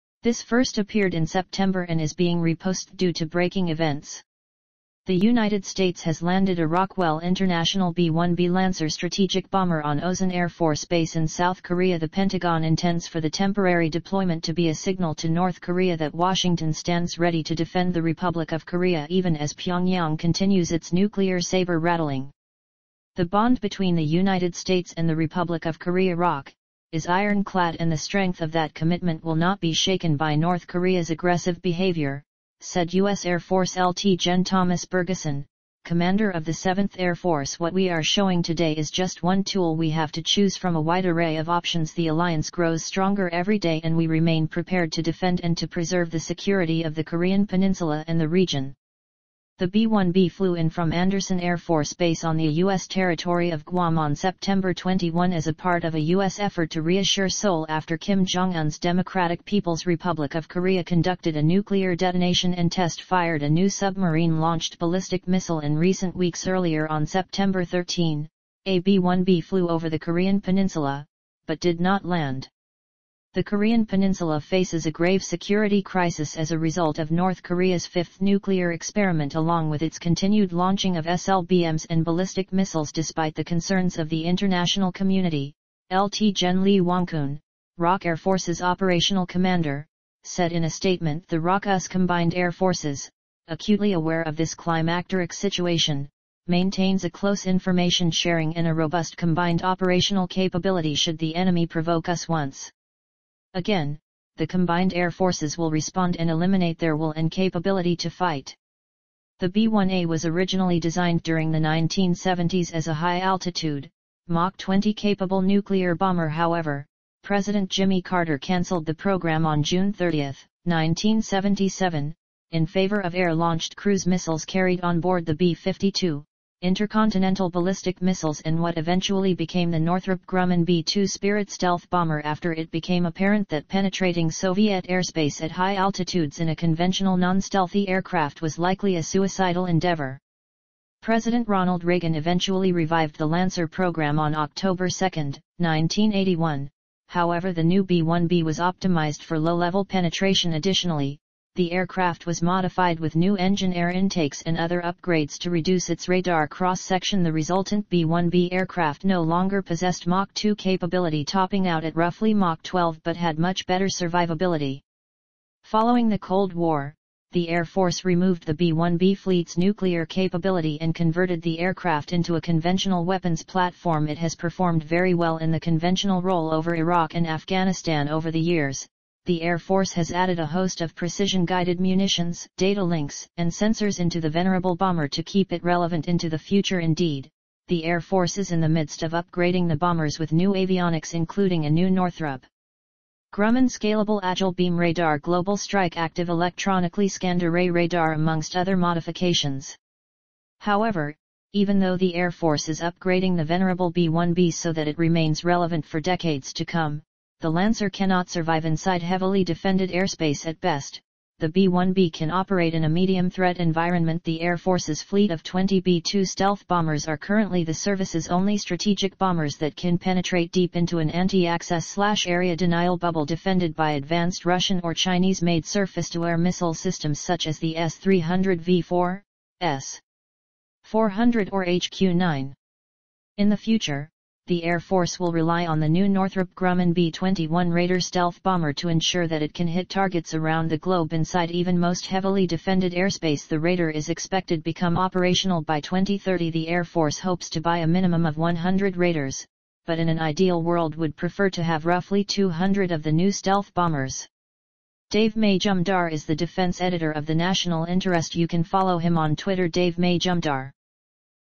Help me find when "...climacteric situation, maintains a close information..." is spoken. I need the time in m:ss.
1:34.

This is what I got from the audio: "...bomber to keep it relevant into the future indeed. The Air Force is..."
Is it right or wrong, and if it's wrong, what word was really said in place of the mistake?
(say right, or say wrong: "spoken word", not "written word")
right.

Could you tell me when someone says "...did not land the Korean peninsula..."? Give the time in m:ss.
1:11.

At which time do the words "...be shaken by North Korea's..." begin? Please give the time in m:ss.
0:29.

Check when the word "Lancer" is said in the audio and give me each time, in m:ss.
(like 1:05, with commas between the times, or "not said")
0:08, 2:23, 3:27.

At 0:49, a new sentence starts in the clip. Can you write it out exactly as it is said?
The B-1B flew in from Andersen Air Force Base on the U.S.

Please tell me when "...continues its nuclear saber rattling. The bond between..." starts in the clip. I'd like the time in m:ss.
0:20.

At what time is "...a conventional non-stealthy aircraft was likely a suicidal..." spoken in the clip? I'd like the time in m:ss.
2:16.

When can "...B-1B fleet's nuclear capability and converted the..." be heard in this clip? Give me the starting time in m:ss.
2:48.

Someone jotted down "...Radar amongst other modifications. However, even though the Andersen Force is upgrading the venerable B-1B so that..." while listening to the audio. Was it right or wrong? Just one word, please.
wrong.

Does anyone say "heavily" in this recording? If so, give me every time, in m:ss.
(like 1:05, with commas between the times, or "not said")
3:29, 4:02.